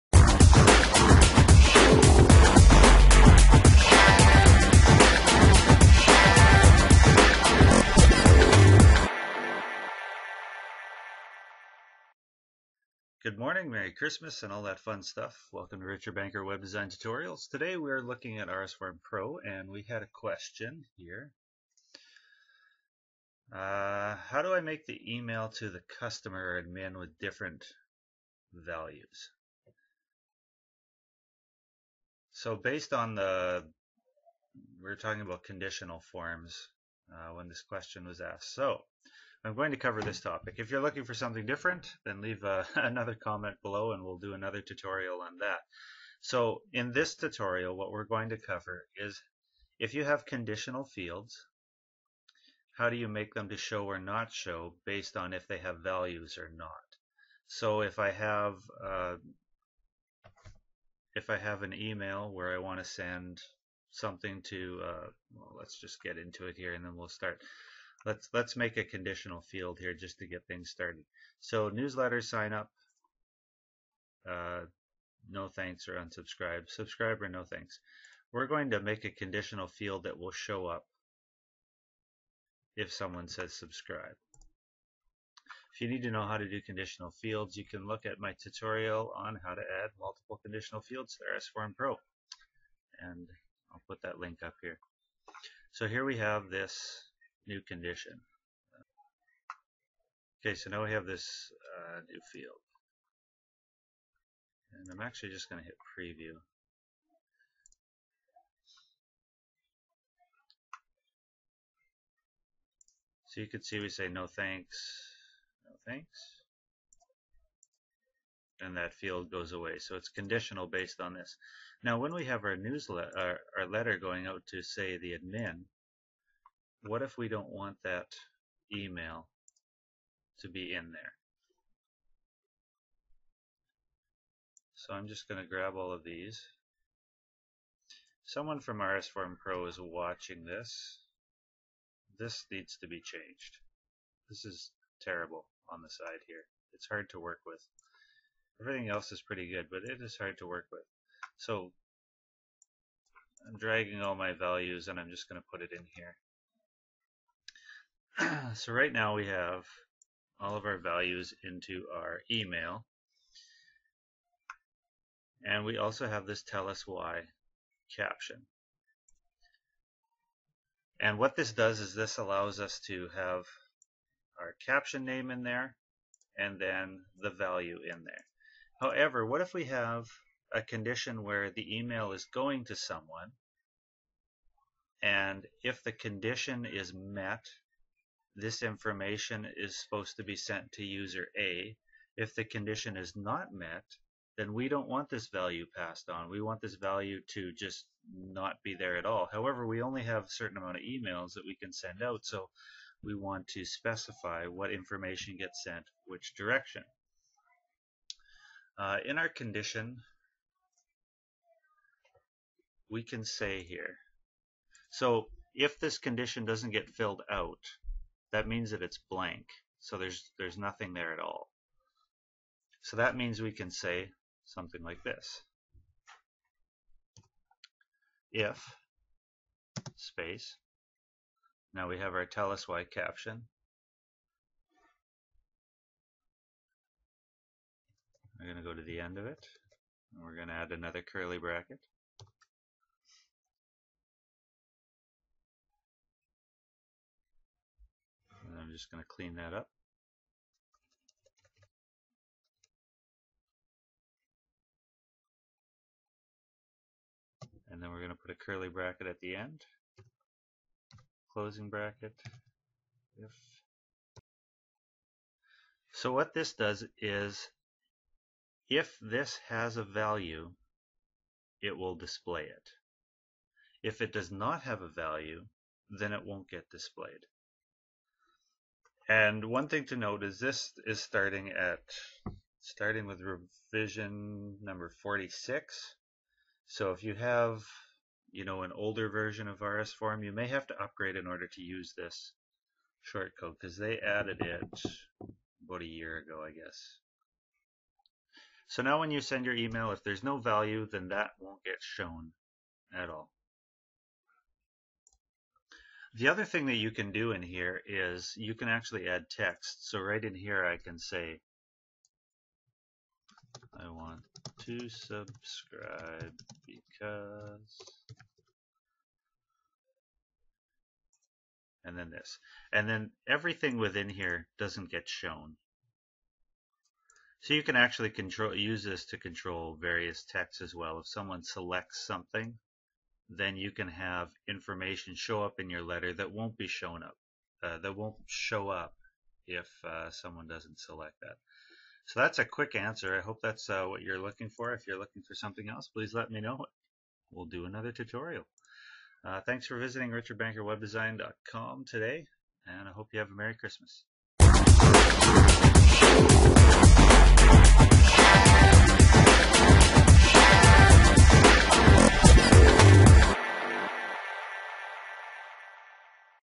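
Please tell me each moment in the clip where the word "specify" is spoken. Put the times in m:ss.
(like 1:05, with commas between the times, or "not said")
3:23.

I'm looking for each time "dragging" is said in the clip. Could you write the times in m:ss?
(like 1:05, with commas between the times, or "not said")
2:33.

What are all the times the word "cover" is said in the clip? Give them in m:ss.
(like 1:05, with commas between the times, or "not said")
0:39, 0:48.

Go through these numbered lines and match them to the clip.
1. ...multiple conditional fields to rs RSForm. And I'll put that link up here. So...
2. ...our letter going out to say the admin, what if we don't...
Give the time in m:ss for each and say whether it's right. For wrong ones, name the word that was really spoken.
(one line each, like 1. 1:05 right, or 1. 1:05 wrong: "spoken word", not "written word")
1. 1:29 wrong: "Pro", not "RSForm"
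2. 2:03 right.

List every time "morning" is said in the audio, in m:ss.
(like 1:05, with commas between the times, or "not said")
0:13.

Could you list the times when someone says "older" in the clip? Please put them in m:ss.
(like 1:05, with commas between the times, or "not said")
4:48.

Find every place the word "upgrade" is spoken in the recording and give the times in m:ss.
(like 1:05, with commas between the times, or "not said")
4:50.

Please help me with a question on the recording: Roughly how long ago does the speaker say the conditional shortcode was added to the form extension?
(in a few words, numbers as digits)
about a year ago.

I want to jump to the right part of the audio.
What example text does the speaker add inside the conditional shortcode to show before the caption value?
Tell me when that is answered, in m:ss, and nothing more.
5:13.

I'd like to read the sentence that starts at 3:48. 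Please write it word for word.
If space, now we have our tell us why caption.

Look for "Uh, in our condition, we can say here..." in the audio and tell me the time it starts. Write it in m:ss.
3:28.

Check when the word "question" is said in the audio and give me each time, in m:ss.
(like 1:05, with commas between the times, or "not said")
0:20, 0:37.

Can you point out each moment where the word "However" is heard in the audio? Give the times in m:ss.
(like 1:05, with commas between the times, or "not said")
2:58, 3:19.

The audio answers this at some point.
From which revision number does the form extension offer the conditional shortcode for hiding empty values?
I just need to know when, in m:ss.
4:45.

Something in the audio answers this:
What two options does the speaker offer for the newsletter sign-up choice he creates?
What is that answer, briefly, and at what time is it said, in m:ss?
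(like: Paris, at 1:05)
Subscribe or no thanks, at 1:16.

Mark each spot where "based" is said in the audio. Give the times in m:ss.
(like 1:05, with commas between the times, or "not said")
0:32, 0:54, 2:00.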